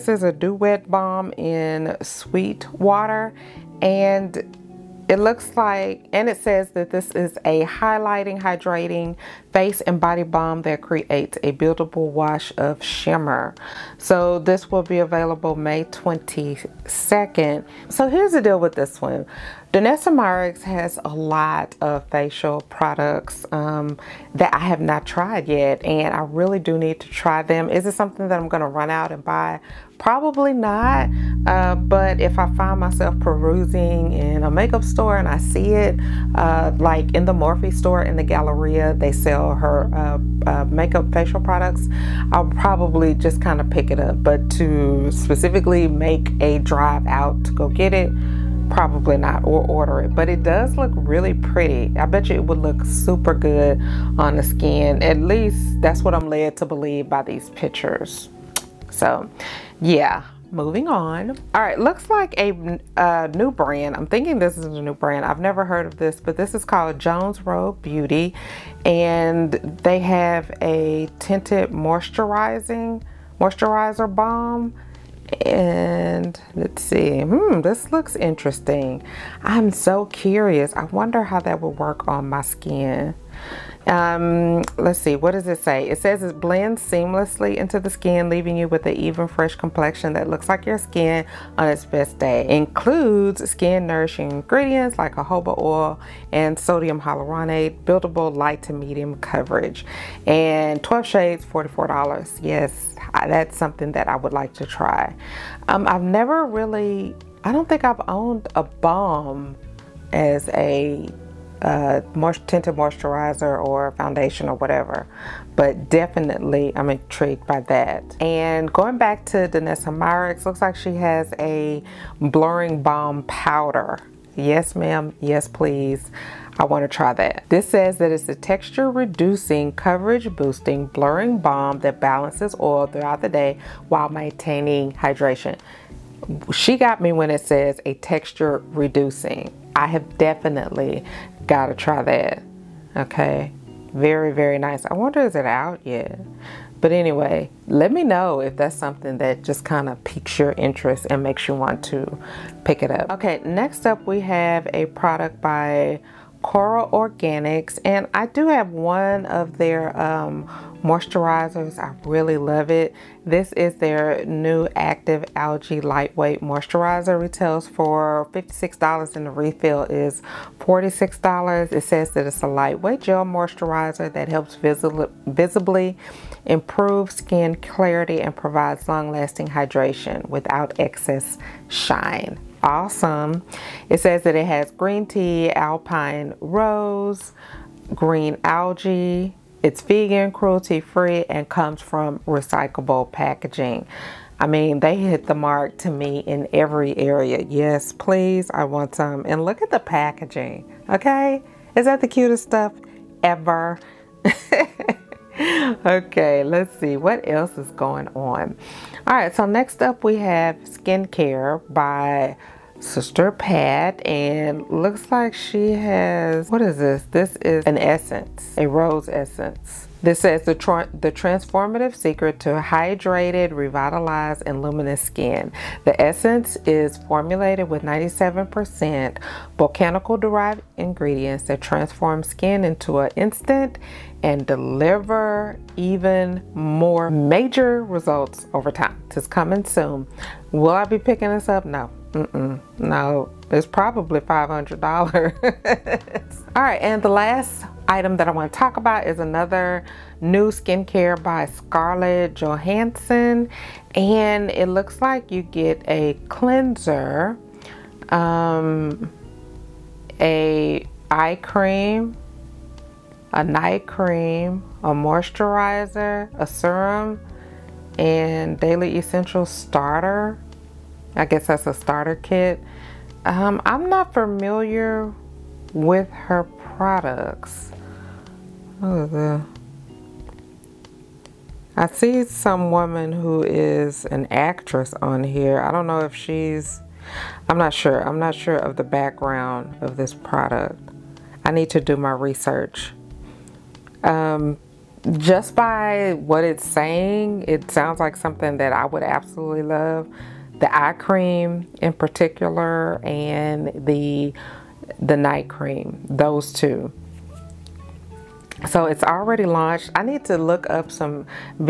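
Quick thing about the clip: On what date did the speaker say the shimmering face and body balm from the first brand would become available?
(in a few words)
May 22.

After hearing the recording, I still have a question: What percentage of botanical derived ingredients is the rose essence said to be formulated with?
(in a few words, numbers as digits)
97%.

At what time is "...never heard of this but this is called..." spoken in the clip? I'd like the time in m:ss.
1:05.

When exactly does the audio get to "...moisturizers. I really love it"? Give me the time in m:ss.
2:40.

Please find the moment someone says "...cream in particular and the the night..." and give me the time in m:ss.
5:00.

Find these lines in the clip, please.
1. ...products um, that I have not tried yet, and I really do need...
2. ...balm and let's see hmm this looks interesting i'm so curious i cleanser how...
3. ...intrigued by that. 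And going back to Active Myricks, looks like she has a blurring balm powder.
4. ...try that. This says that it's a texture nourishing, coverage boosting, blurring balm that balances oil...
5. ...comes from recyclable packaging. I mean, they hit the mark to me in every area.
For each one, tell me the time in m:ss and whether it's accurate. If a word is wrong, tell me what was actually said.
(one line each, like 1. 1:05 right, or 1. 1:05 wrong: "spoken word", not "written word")
1. 0:22 right
2. 1:14 wrong: "wonder", not "cleanser"
3. 1:56 wrong: "Danessa", not "Active"
4. 2:06 wrong: "reducing", not "nourishing"
5. 3:11 right.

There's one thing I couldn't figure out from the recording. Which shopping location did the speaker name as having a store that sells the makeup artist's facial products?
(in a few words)
the Galleria.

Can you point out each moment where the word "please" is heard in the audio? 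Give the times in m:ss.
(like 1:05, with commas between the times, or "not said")
2:05, 3:17.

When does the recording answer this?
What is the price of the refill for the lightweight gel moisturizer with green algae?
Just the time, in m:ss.
2:50.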